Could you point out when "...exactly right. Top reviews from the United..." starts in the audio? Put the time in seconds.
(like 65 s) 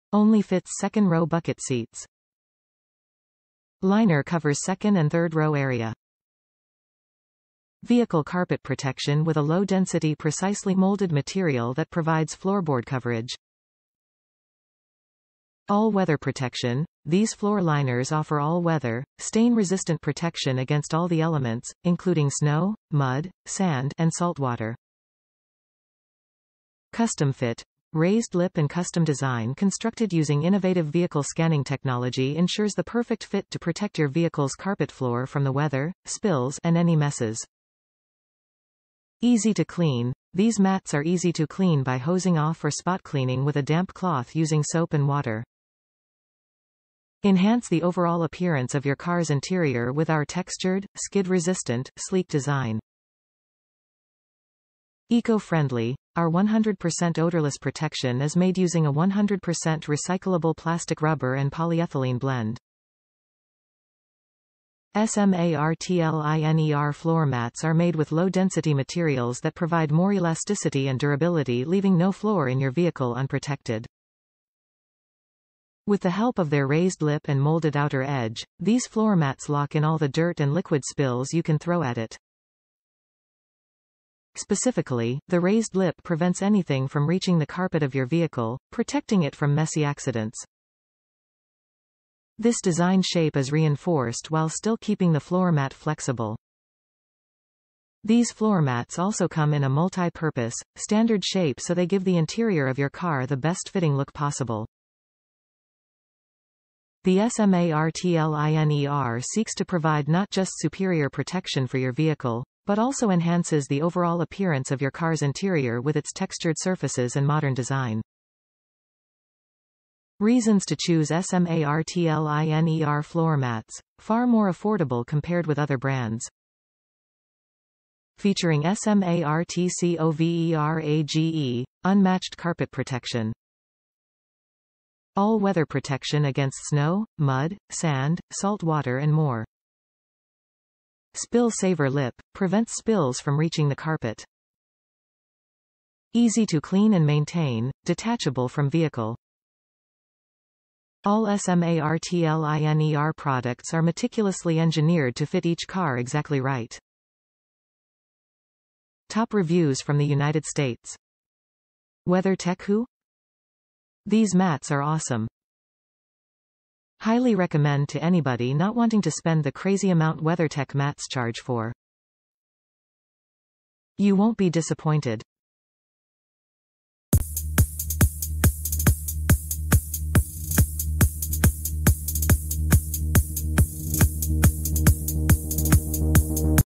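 155 s.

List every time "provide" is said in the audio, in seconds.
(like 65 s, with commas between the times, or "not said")
11 s, 69 s, 109 s.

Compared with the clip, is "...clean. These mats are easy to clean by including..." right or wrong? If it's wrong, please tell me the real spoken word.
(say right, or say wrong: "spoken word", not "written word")
wrong: "hosing", not "including".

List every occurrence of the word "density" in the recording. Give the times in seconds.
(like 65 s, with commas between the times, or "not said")
9 s, 68 s.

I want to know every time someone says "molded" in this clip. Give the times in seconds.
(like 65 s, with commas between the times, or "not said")
10 s, 77 s.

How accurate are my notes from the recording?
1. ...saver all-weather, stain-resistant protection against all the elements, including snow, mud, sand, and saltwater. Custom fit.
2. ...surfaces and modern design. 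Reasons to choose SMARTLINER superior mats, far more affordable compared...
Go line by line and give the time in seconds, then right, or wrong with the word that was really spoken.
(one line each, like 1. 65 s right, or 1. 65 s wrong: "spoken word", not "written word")
1. 18 s wrong: "offer", not "saver"
2. 116 s wrong: "floor", not "superior".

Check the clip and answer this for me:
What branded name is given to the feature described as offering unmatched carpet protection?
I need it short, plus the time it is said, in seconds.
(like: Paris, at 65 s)
SMARTCOVERAGE, at 128 s.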